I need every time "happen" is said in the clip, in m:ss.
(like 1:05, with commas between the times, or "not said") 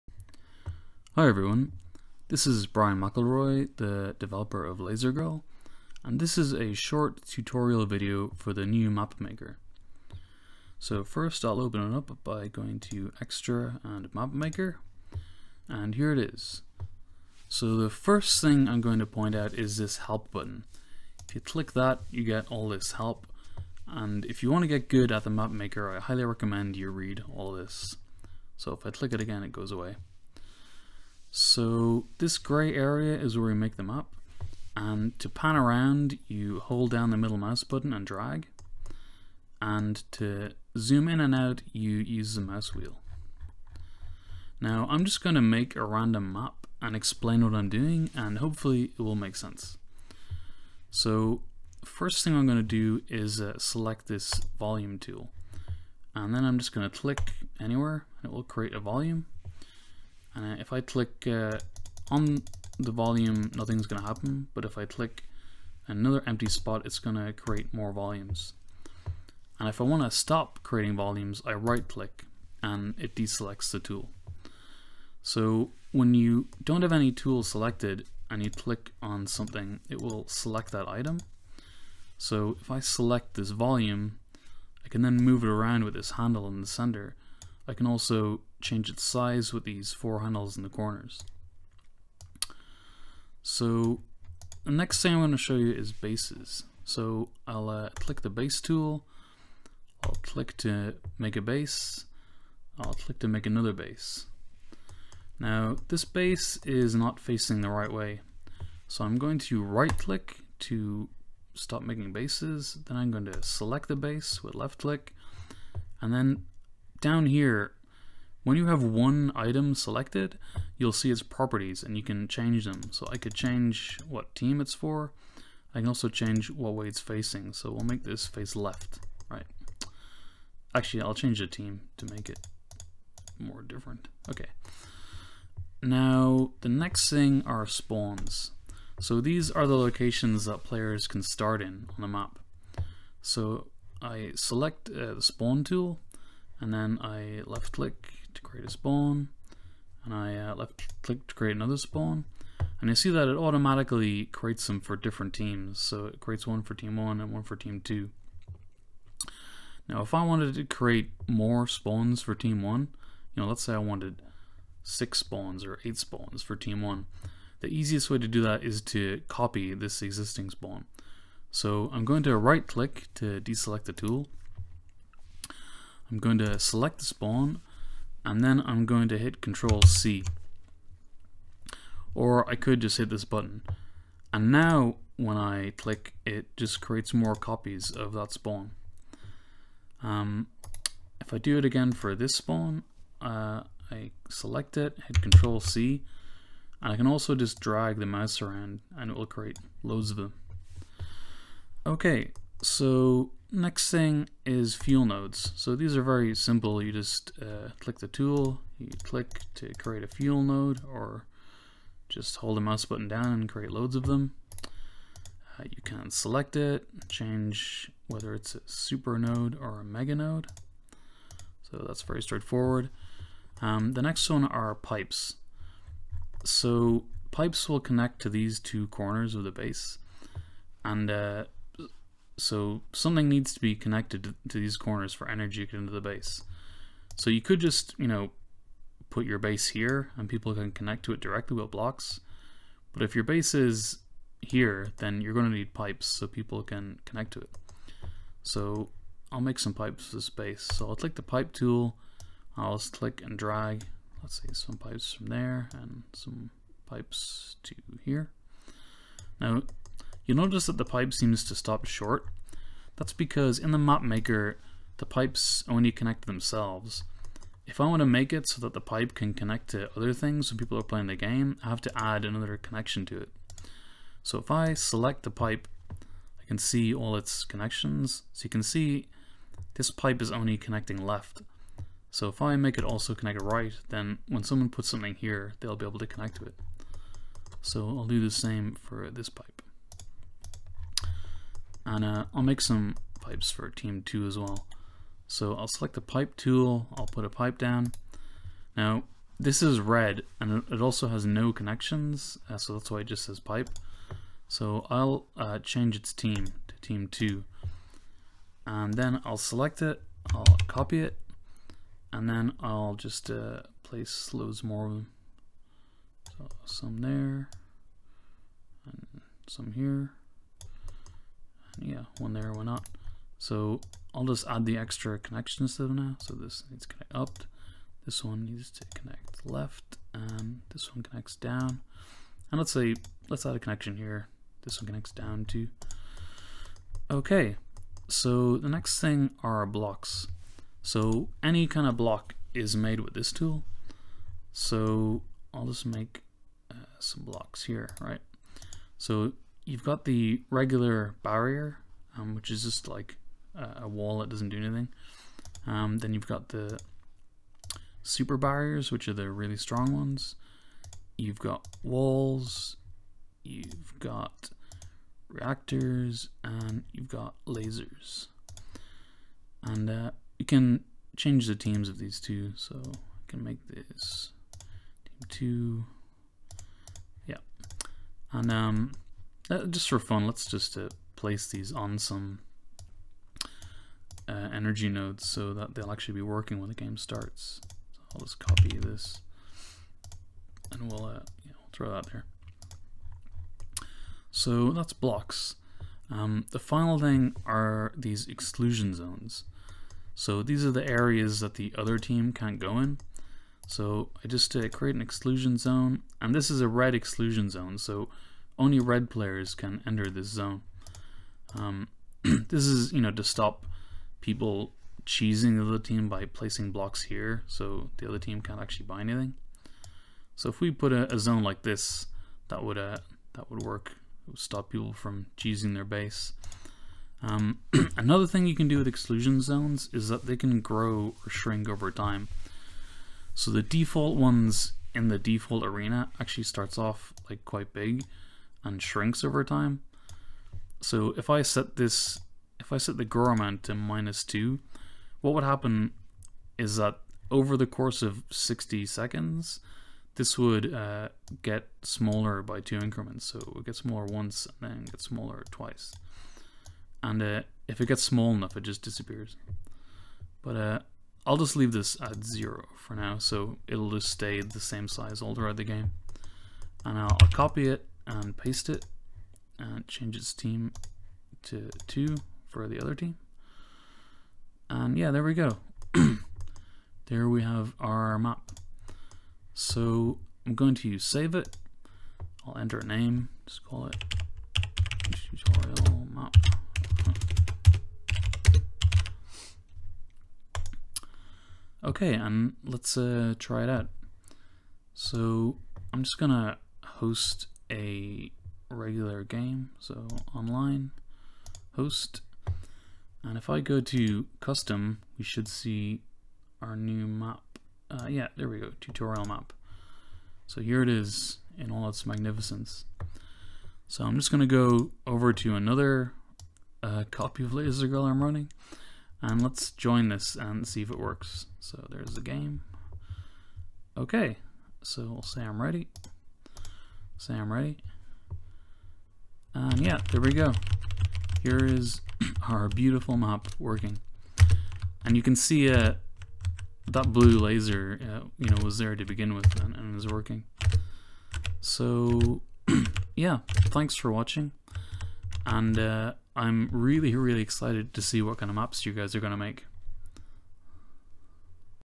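1:04, 7:25.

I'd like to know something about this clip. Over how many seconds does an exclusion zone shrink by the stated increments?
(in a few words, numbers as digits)
60.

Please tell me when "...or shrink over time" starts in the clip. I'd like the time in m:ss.
7:11.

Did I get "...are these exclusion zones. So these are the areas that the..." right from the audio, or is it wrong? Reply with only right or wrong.
right.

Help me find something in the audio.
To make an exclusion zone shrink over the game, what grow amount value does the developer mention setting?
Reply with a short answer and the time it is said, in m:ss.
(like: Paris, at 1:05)
-2, at 7:23.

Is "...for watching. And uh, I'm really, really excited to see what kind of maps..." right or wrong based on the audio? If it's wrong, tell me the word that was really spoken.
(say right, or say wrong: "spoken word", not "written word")
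right.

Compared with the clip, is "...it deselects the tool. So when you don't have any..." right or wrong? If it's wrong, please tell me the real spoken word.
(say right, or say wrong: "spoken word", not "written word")
right.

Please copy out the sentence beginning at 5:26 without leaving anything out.
So this needs to connect up, this one needs to connect left, and this one connects down.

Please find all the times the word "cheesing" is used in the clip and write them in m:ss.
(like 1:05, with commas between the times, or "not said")
6:55, 7:05.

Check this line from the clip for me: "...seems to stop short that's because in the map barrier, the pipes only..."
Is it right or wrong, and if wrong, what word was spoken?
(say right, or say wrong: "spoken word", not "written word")
wrong: "maker", not "barrier".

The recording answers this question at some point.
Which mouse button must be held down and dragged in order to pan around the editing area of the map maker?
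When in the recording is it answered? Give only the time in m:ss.
0:37.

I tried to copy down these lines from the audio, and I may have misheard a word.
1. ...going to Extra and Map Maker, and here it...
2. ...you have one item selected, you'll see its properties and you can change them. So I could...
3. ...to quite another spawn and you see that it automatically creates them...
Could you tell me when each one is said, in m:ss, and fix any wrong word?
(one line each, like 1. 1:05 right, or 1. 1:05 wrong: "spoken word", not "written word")
1. 0:12 right
2. 1:58 right
3. 2:31 wrong: "create", not "quite".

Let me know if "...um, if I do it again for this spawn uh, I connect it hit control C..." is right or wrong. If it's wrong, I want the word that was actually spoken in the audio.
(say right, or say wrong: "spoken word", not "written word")
wrong: "select", not "connect".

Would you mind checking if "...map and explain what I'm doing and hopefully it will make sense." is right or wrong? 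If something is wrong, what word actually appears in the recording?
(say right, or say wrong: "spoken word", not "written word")
right.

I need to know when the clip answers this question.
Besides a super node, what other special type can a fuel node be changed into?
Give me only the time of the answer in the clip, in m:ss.
3:39.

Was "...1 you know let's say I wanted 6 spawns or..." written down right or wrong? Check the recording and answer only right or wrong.
right.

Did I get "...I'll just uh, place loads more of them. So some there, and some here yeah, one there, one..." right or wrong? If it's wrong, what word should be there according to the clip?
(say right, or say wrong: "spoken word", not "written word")
right.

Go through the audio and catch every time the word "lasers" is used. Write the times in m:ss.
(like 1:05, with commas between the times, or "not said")
6:07, 8:57.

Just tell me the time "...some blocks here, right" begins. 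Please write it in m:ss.
5:46.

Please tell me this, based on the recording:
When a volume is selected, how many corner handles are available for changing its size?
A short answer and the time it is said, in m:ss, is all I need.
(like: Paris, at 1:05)
4, at 1:29.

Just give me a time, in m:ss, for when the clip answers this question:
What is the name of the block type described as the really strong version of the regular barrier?
5:58.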